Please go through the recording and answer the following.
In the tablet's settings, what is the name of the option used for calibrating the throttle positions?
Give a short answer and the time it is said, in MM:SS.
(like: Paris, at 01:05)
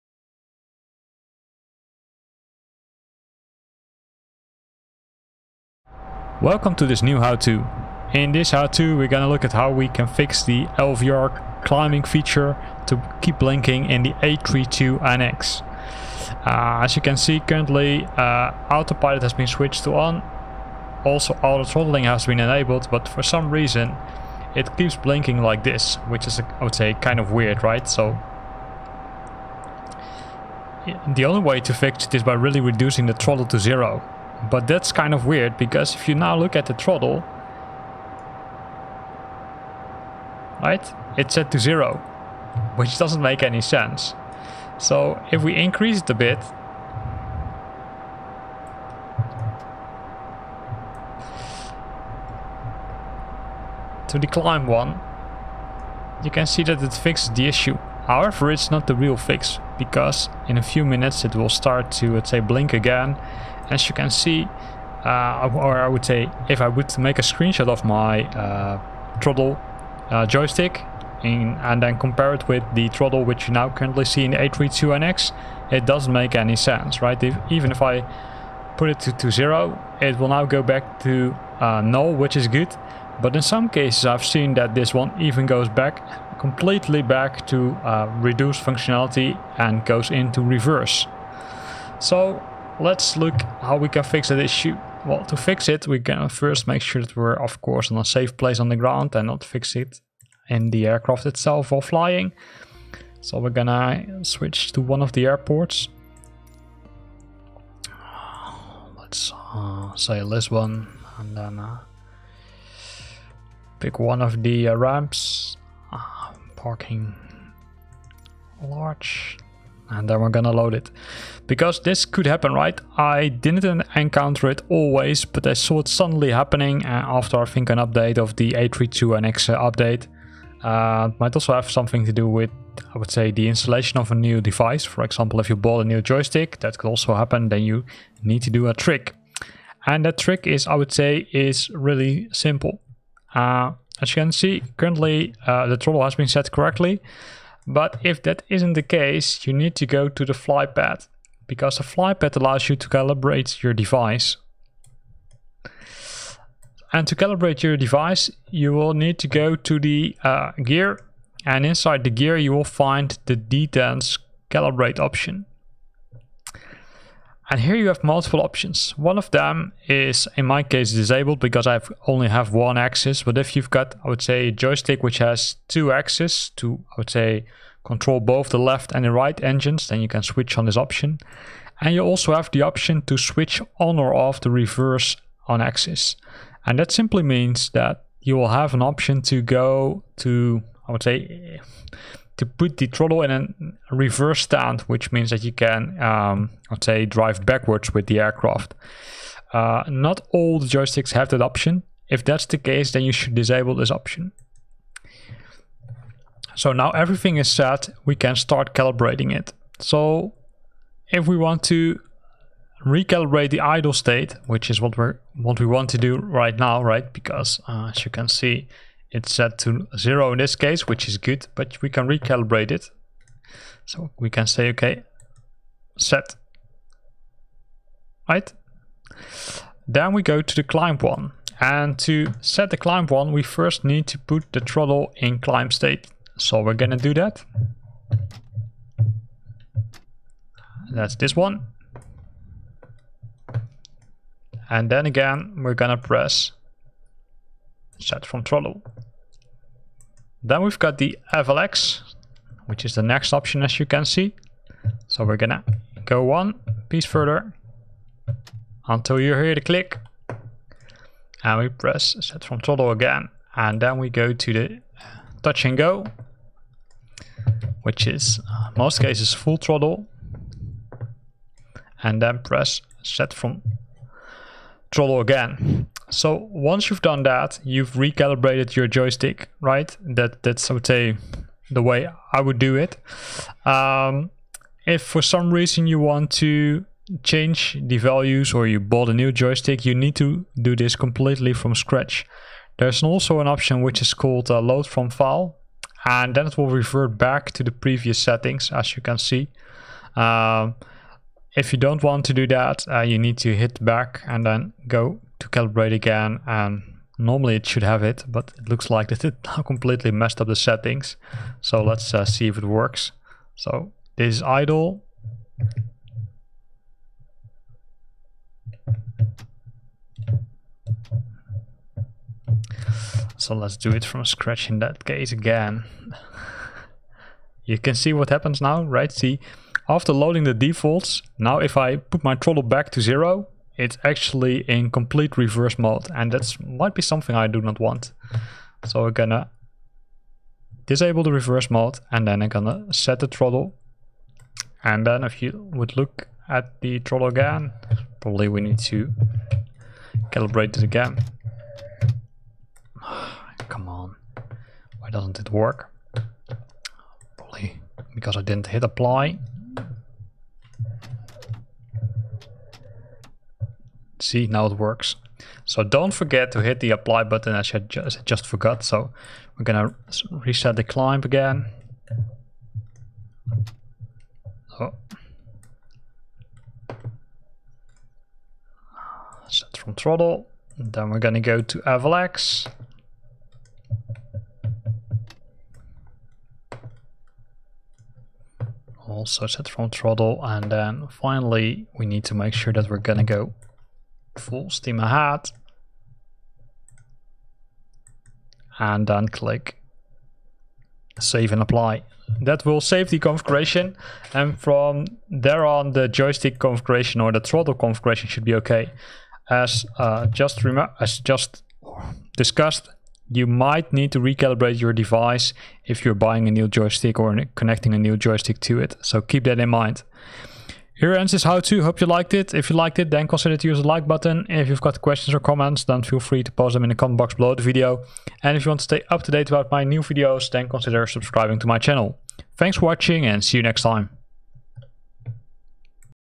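Detents calibrate, at 02:43.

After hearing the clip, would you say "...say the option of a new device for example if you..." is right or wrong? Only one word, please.
wrong.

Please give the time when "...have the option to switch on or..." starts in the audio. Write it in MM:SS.
03:02.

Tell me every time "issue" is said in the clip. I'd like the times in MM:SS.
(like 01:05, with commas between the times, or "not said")
00:57, 01:34.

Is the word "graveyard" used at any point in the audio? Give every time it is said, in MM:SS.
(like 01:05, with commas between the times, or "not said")
not said.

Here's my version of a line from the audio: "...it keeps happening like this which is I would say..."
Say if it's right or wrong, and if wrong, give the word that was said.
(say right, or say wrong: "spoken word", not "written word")
wrong: "blinking", not "happening".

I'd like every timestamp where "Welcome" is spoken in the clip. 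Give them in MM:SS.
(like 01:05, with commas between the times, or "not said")
00:06.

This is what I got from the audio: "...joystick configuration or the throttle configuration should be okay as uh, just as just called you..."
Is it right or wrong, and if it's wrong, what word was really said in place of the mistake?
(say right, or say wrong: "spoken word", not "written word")
wrong: "discussed", not "called".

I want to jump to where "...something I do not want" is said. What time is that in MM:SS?
05:37.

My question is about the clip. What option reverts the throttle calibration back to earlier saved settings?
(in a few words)
Load from file.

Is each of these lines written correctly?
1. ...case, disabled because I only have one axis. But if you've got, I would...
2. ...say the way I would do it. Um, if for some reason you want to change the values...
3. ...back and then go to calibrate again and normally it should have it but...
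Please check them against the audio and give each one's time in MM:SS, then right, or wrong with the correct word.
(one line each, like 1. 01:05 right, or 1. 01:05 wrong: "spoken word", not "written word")
1. 02:50 right
2. 04:40 right
3. 05:03 right.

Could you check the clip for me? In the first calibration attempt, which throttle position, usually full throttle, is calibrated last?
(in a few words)
Touch and go.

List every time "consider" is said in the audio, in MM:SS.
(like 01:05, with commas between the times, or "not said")
07:03, 07:10.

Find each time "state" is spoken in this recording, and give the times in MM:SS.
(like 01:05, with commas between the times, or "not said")
03:33, 03:55.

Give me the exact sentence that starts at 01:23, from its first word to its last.
But in some cases I've seen that this one even goes back completely back to uh, reduce functionality and goes into reverse.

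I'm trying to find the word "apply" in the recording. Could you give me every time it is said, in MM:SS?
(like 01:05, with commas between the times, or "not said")
05:58, 06:06, 06:41.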